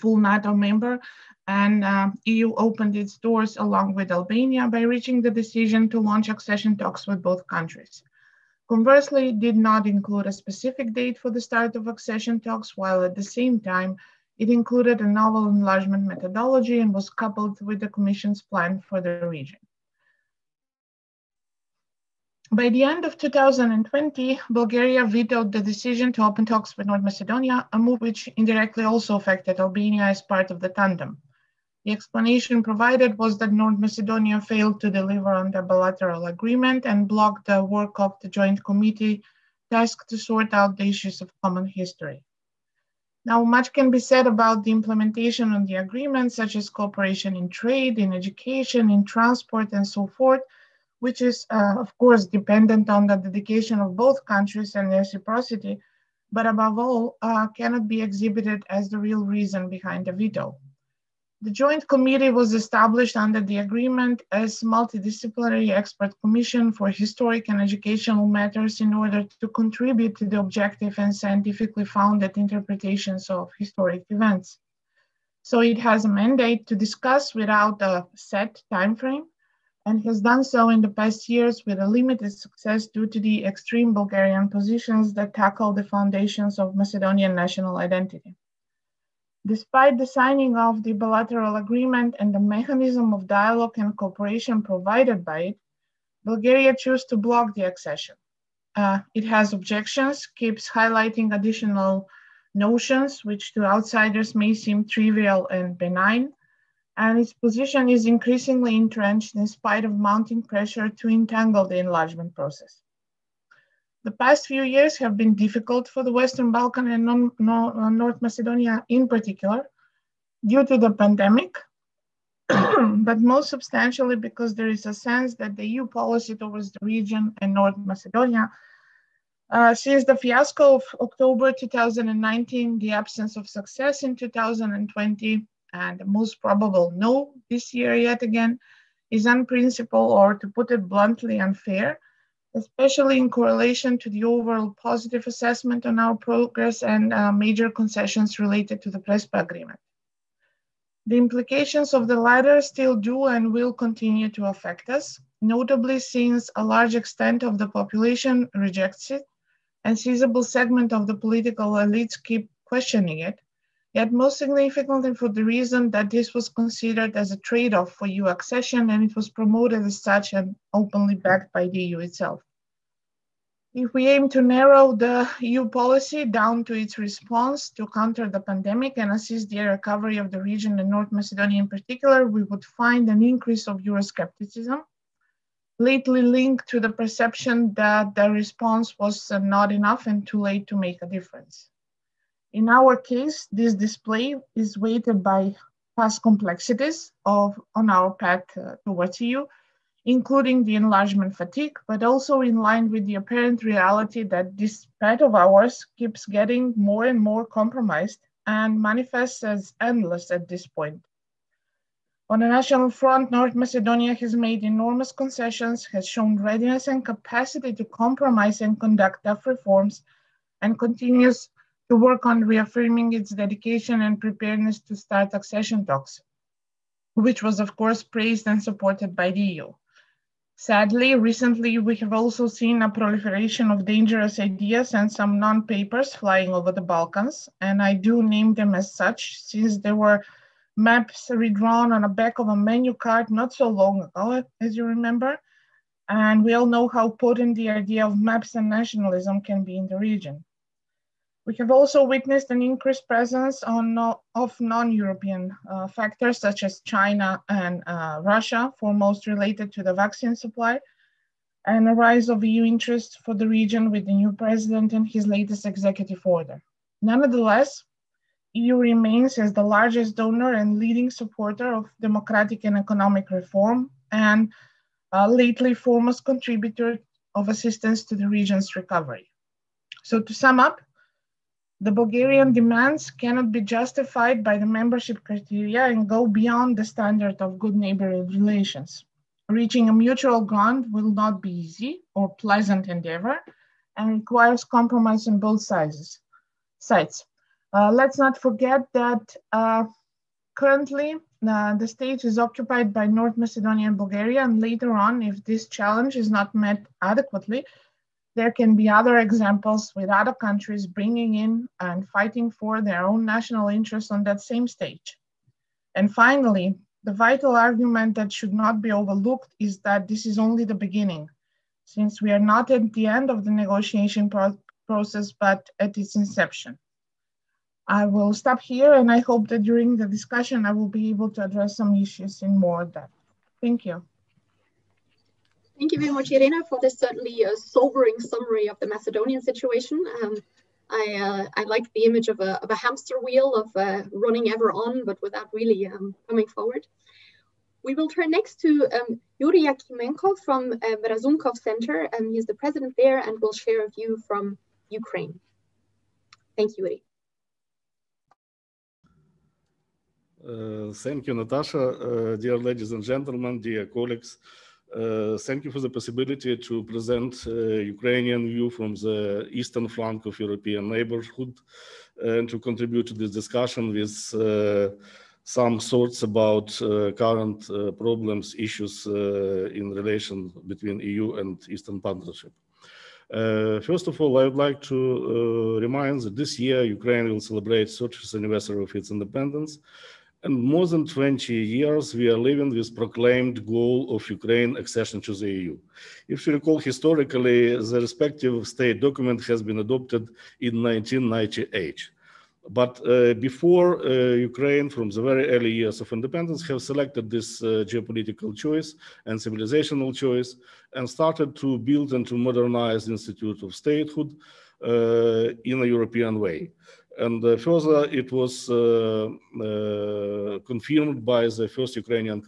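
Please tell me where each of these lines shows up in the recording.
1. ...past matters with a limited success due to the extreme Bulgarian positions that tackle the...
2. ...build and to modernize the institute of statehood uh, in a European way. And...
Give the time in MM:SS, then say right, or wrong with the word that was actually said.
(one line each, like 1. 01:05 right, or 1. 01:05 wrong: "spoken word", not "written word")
1. 01:20 wrong: "years", not "matters"
2. 06:51 right.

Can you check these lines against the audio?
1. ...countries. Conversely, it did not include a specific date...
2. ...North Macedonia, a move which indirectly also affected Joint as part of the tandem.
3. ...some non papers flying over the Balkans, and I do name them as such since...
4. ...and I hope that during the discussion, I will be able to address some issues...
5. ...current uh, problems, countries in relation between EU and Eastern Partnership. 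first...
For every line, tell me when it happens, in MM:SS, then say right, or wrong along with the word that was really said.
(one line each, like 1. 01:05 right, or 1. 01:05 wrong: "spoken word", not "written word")
1. 00:07 right
2. 00:26 wrong: "Albania", not "Joint"
3. 03:55 right
4. 05:28 right
5. 06:17 wrong: "issues", not "countries".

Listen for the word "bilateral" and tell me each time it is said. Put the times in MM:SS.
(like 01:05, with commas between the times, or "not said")
00:35, 01:30.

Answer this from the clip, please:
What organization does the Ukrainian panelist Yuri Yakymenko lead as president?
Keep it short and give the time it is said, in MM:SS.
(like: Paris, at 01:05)
Razumkov Center, at 05:51.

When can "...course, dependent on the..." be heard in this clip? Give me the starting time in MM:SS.
00:51.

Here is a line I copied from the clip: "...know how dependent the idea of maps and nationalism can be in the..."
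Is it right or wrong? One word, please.
wrong.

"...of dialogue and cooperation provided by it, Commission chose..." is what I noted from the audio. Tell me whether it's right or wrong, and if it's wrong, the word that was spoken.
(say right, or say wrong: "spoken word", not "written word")
wrong: "Bulgaria", not "Commission".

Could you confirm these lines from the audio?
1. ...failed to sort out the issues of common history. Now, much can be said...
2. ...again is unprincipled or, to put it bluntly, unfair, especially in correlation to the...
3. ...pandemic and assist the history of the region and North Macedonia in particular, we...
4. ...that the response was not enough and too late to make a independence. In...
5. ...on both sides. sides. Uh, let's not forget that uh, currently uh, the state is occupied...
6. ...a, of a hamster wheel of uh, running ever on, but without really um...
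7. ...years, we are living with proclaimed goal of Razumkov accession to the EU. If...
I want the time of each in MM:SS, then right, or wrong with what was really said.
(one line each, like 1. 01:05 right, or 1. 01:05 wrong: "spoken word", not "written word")
1. 00:39 wrong: "tasked", not "failed"
2. 02:18 right
3. 02:58 wrong: "recovery", not "history"
4. 03:07 wrong: "difference", not "independence"
5. 04:55 right
6. 05:42 right
7. 06:31 wrong: "Ukraine", not "Razumkov".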